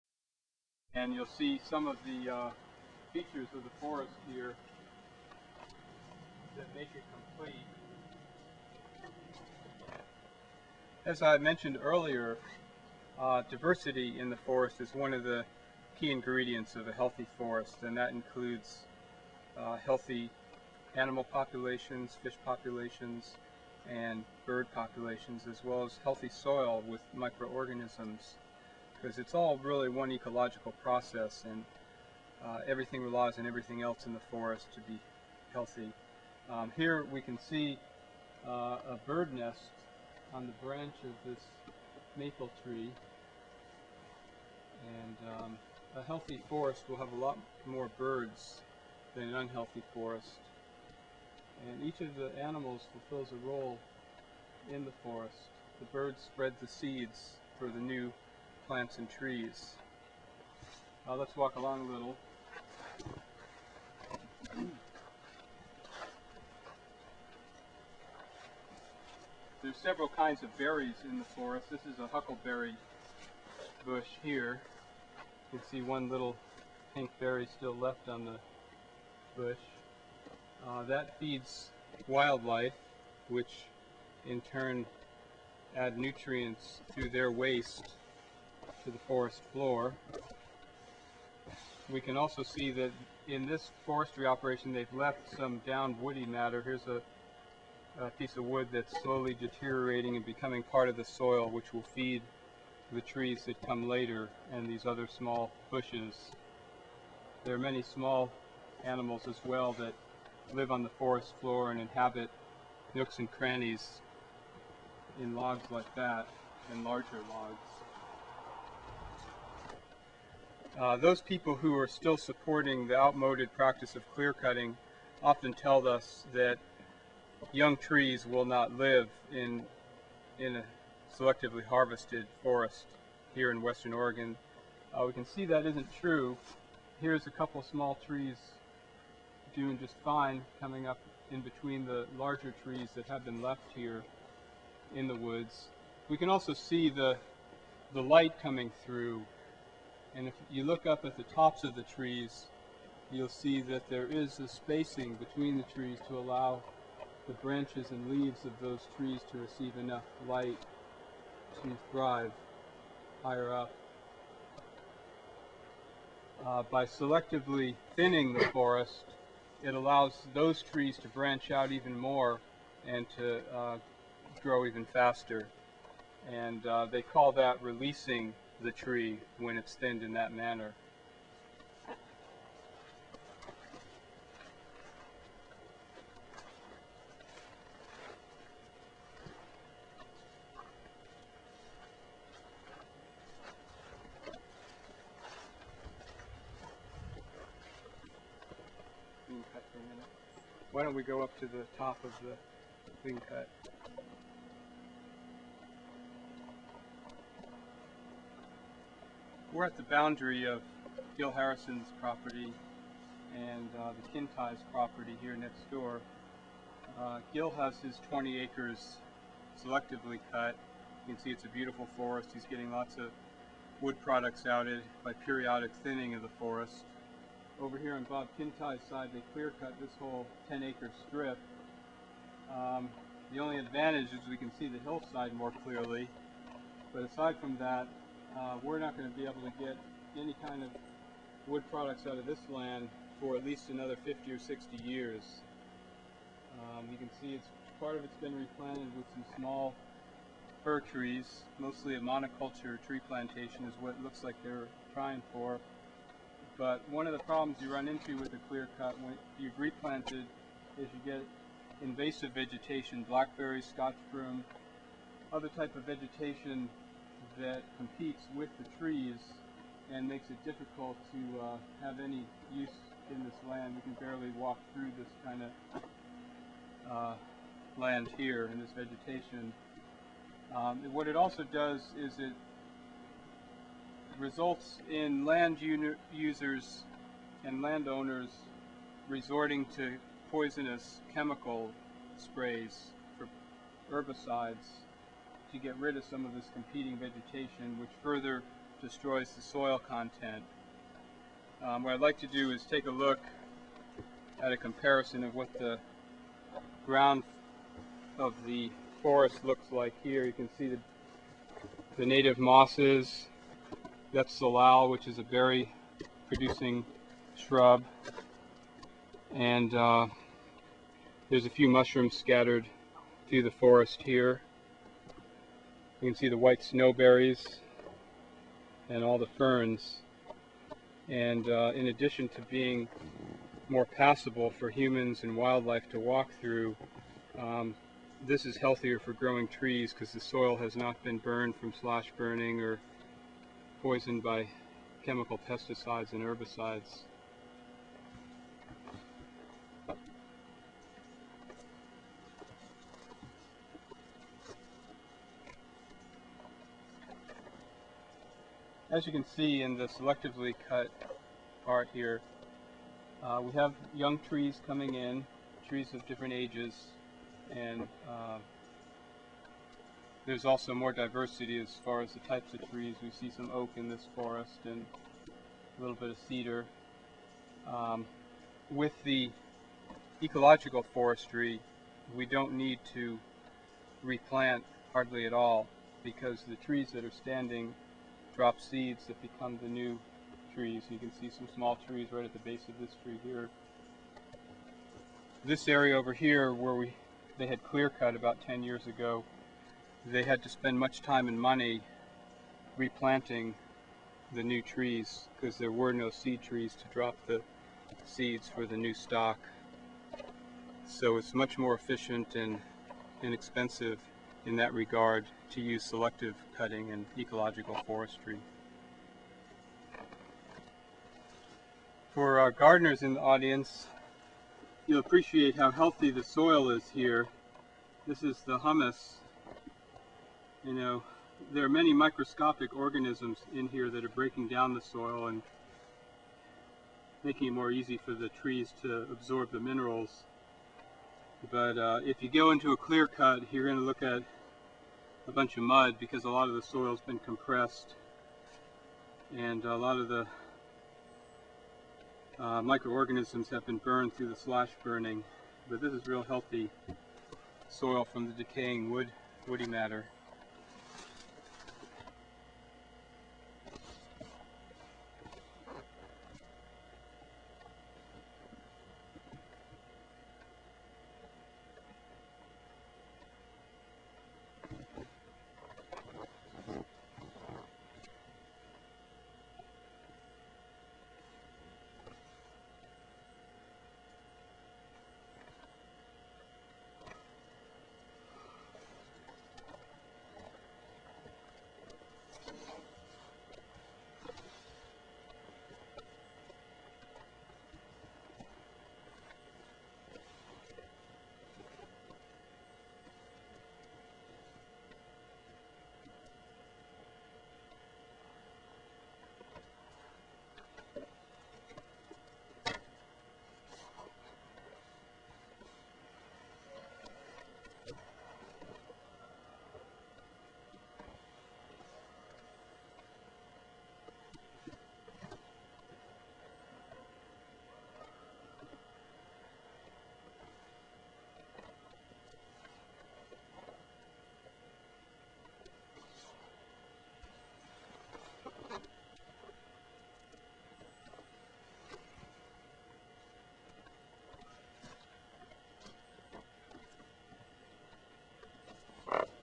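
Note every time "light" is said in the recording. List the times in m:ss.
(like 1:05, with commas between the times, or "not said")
2:28, 2:40.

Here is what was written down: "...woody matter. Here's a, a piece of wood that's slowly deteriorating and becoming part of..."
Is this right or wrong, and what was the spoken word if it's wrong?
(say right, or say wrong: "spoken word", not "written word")
right.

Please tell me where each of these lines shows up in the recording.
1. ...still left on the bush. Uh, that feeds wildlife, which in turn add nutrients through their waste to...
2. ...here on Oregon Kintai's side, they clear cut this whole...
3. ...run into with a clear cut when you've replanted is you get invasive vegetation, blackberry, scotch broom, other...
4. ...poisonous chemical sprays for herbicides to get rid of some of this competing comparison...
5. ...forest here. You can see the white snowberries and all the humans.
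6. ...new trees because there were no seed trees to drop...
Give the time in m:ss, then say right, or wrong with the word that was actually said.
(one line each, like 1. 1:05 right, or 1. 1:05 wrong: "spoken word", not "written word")
1. 1:17 right
2. 3:47 wrong: "Bob", not "Oregon"
3. 4:17 right
4. 4:50 wrong: "vegetation", not "comparison"
5. 5:23 wrong: "ferns", not "humans"
6. 6:44 right.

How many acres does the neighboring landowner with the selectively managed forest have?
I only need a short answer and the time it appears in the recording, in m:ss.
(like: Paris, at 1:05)
20, at 3:38.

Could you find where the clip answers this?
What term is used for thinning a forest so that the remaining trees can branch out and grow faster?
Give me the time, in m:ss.
2:57.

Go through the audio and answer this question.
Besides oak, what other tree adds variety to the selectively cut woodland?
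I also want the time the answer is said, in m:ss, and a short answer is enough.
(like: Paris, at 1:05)
cedar, at 6:16.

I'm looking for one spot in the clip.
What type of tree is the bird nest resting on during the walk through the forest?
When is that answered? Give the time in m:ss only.
0:42.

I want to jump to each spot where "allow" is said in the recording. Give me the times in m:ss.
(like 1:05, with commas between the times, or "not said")
2:36, 2:49.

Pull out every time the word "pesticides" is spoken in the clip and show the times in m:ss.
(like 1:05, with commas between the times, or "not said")
5:45.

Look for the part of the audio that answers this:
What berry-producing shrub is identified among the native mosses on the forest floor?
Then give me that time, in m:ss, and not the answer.
5:14.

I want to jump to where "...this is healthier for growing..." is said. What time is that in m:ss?
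5:38.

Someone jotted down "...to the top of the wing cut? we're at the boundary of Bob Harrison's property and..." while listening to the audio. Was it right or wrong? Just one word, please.
wrong.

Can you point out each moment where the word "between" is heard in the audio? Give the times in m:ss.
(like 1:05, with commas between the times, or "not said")
2:21, 2:35.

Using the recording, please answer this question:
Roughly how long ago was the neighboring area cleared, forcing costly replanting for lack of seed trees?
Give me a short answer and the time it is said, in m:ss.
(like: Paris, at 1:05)
10 years, at 6:38.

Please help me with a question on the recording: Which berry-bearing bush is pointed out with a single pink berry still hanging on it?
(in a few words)
huckleberry.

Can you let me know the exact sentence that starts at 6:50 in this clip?
So it's much more efficient and inexpensive in that regard to use selective cutting and ecological forestry.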